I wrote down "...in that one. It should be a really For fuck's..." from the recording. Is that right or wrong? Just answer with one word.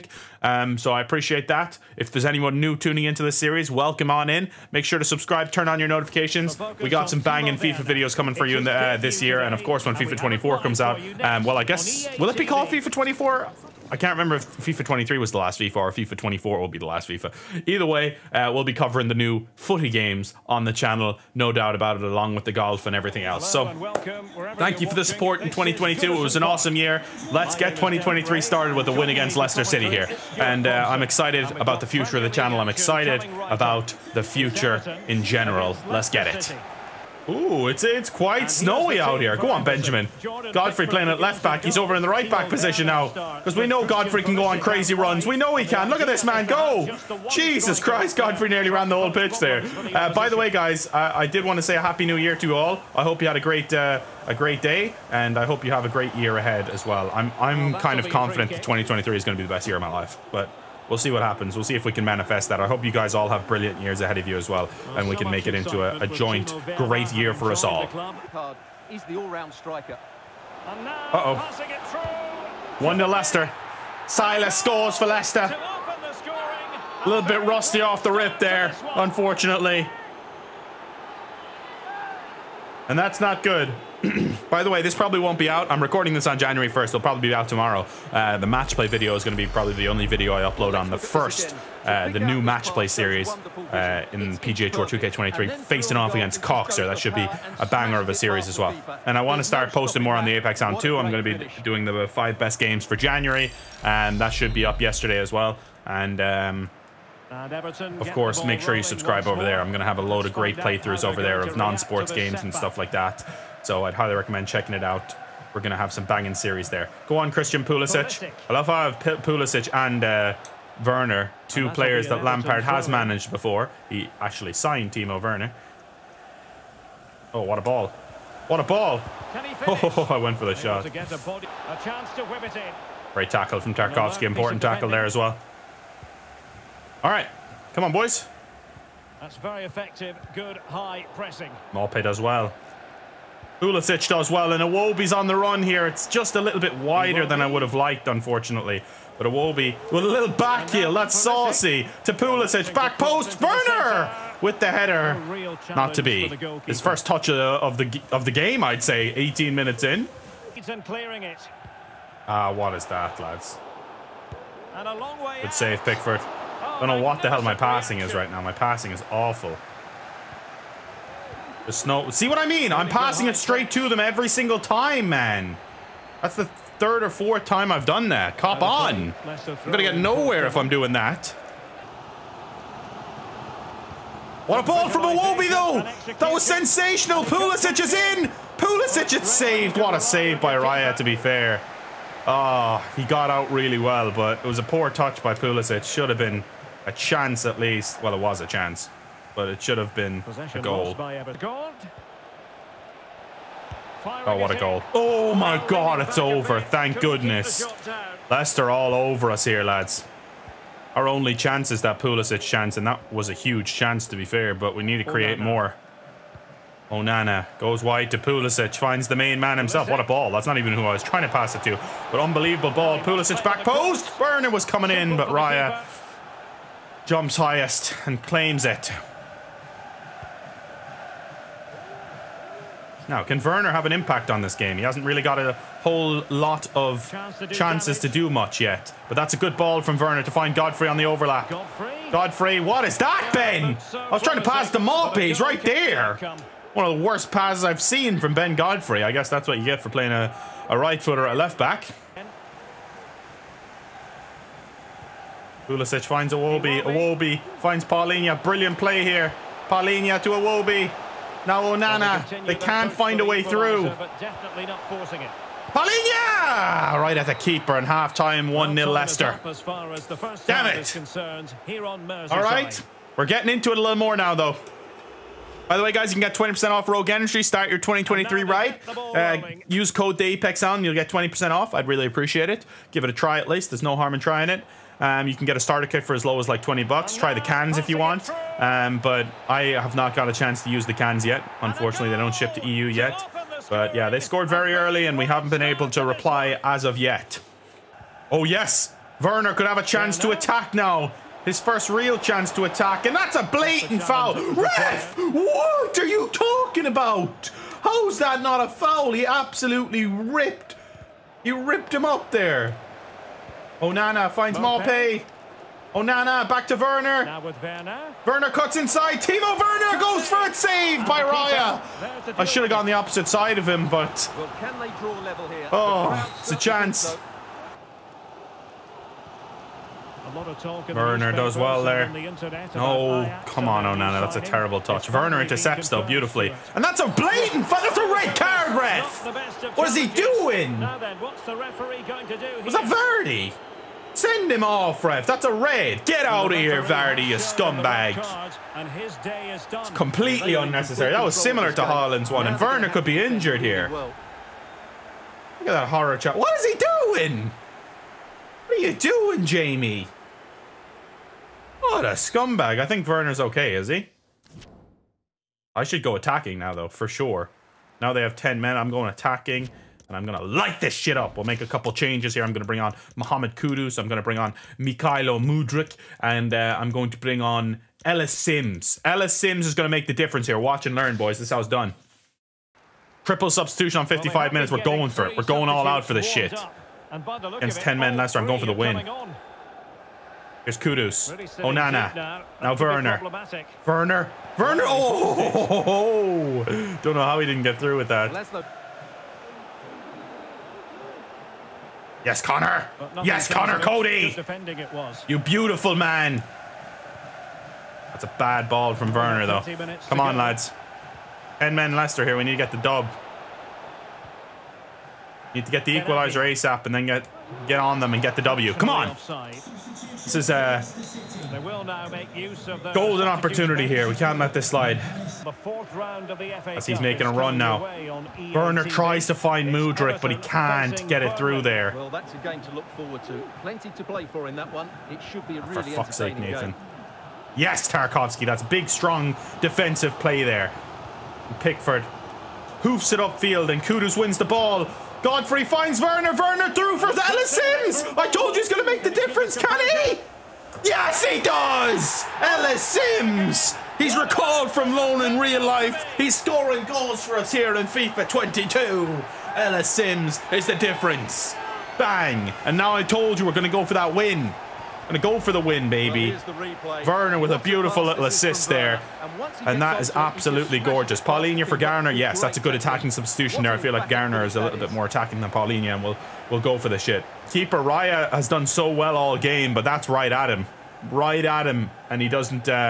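right.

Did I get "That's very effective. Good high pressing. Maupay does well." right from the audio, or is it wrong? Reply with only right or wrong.
right.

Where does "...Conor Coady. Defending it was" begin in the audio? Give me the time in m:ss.
6:43.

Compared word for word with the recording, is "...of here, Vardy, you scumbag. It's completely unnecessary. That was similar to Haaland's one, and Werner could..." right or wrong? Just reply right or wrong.
right.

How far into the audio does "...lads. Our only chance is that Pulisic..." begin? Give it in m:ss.
3:29.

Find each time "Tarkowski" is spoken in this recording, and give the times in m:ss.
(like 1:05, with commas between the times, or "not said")
2:13, 7:17.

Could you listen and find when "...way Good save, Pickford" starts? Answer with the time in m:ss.
2:45.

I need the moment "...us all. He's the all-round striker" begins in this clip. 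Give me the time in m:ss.
1:07.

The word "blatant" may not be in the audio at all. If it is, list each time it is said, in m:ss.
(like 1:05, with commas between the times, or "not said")
5:03, 5:37.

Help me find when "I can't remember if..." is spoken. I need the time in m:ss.
0:13.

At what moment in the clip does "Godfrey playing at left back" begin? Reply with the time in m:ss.
0:40.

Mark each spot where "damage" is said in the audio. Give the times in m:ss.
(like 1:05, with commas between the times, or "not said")
3:57.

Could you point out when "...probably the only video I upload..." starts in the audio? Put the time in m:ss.
1:29.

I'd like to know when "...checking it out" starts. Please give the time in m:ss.
1:54.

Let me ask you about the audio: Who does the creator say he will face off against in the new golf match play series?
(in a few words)
Coxer.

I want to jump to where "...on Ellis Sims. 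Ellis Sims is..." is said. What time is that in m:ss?
6:17.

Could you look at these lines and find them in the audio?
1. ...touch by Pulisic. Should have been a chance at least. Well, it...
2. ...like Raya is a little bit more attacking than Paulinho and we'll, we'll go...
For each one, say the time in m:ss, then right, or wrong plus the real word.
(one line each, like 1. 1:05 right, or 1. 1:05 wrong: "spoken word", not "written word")
1. 3:14 right
2. 7:53 wrong: "Garner", not "Raya".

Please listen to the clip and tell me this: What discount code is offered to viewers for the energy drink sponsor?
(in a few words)
Apex Hound.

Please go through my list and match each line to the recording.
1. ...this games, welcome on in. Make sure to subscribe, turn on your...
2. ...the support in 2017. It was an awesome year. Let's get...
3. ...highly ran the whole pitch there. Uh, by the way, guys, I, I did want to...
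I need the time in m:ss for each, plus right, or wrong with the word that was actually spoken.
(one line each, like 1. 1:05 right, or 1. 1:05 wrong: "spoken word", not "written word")
1. 0:03 wrong: "series", not "games"
2. 0:24 wrong: "2022", not "2017"
3. 0:48 wrong: "nearly", not "highly".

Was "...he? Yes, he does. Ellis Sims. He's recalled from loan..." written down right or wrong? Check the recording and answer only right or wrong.
right.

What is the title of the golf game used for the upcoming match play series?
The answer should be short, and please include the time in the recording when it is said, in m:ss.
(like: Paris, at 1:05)
PGA Tour 2K23, at 1:34.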